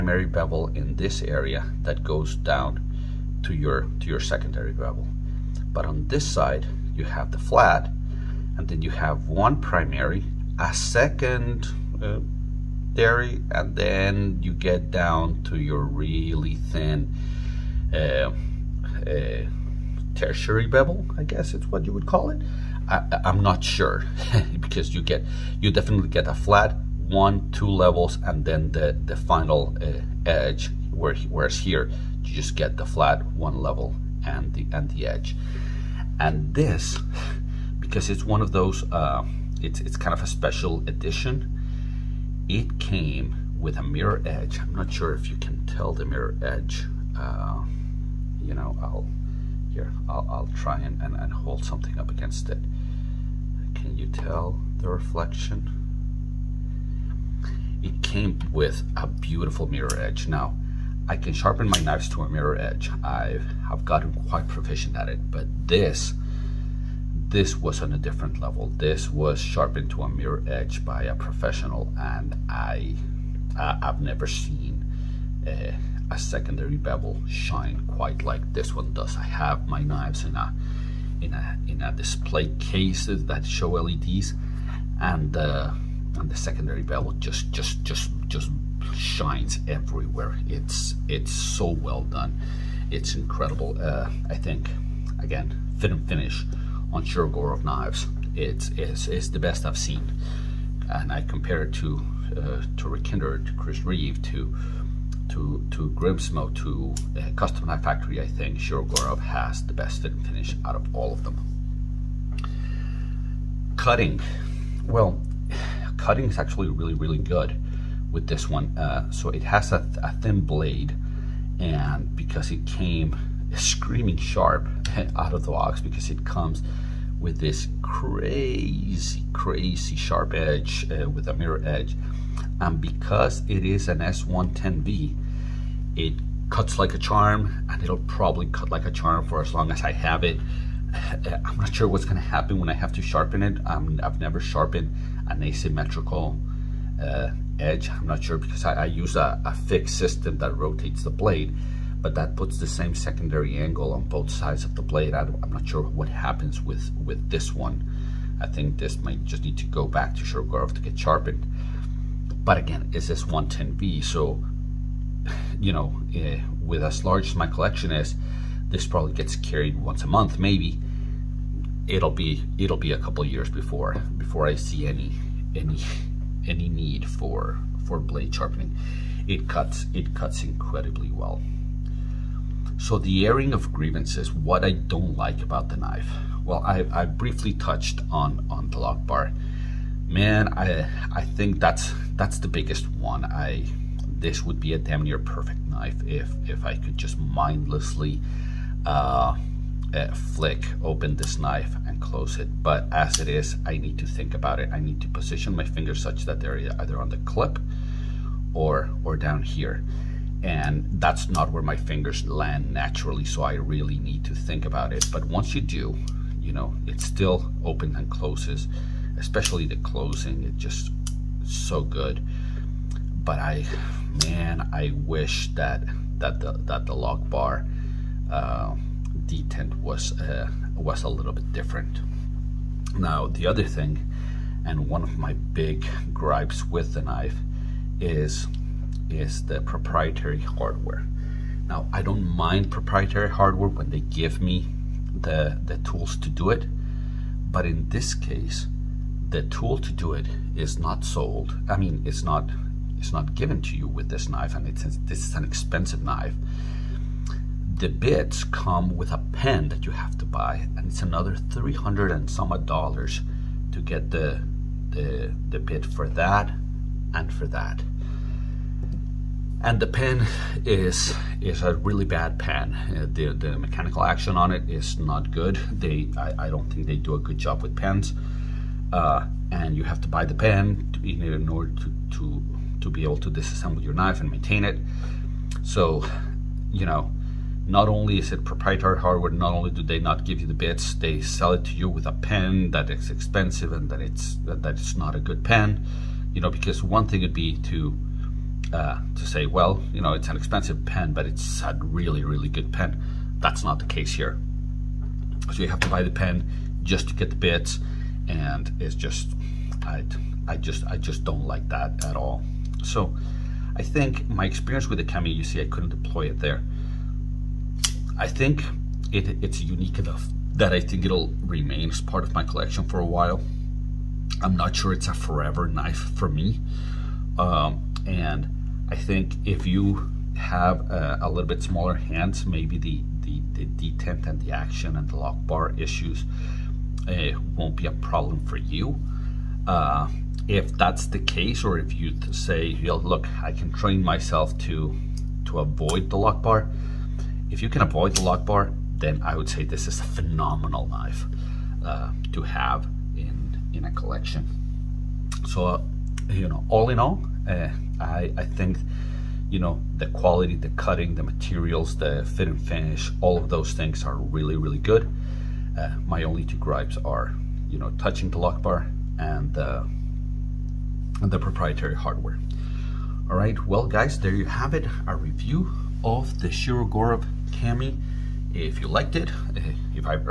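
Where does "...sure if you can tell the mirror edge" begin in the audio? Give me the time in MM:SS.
00:44.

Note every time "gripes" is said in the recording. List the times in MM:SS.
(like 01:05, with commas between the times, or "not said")
03:56, 06:06.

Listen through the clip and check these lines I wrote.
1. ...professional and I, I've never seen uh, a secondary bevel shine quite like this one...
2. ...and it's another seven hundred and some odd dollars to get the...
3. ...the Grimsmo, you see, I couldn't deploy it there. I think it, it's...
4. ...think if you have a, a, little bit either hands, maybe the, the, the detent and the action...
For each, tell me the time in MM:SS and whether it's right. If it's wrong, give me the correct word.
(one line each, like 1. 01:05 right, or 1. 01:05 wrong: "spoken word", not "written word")
1. 01:11 right
2. 04:20 wrong: "three", not "seven"
3. 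05:14 wrong: "Kami", not "Grimsmo"
4. 05:28 wrong: "smaller", not "either".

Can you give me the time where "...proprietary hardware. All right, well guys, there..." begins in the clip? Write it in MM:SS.
06:11.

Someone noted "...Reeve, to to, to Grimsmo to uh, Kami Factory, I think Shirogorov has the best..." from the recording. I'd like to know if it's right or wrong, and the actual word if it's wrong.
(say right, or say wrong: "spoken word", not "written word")
wrong: "Custom", not "Kami".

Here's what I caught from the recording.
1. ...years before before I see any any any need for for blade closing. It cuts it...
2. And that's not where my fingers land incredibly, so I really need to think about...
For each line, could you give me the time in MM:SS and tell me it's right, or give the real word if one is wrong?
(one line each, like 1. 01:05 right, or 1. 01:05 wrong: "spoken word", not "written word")
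1. 02:53 wrong: "sharpening", not "closing"
2. 03:30 wrong: "naturally", not "incredibly".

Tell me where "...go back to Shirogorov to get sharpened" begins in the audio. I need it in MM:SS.
02:39.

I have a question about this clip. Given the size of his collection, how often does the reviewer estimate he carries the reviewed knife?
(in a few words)
Once a month.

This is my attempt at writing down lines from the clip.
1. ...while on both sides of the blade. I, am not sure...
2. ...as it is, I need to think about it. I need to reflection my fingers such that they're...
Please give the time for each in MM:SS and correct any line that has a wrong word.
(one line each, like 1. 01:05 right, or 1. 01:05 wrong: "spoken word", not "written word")
1. 02:33 wrong: "angle", not "while"
2. 03:22 wrong: "position", not "reflection".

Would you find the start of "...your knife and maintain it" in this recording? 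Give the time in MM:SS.
04:43.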